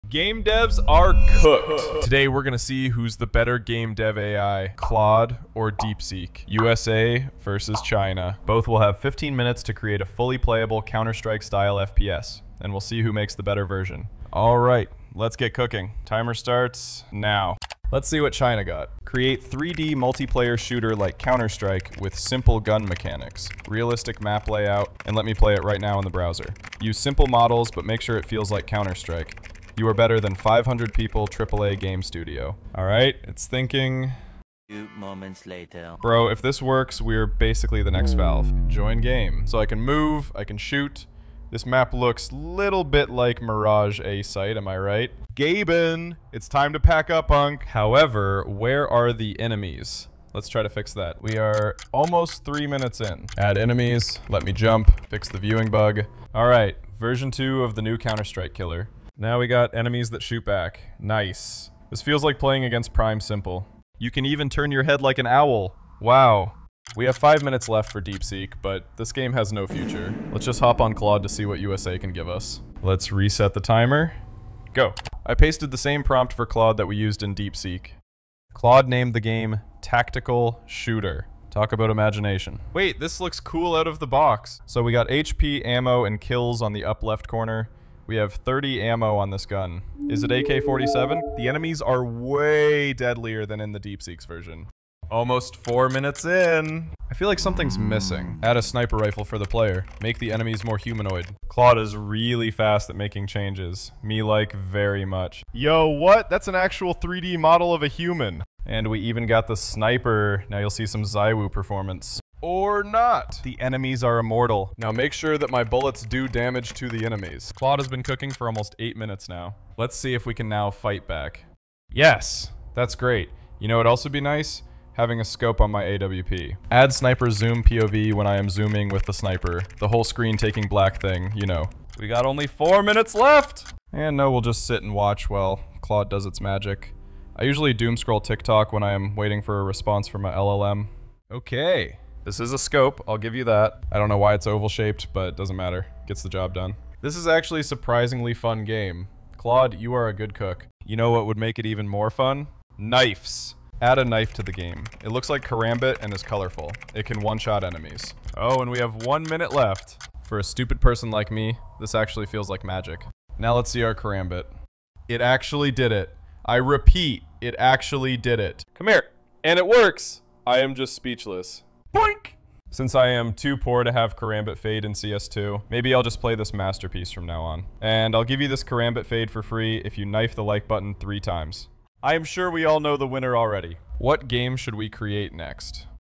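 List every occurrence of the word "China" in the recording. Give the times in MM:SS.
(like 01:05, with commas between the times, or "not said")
00:07, 00:18.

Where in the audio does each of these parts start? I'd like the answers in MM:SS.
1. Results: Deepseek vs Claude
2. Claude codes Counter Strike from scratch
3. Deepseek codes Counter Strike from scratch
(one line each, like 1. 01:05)
1. 03:01
2. 01:13
3. 00:16.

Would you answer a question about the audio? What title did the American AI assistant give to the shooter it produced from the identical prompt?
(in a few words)
Tactical Shooter.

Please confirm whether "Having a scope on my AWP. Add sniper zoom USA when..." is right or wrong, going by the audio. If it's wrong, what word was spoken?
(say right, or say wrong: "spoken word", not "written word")
wrong: "POV", not "USA".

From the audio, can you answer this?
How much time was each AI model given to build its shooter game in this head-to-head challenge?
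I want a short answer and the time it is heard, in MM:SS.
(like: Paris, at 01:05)
15 minutes, at 00:08.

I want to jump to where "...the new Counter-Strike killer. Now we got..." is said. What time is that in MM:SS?
00:57.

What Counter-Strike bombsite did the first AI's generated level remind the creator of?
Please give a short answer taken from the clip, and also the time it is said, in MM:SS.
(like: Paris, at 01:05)
Mirage A site, at 00:43.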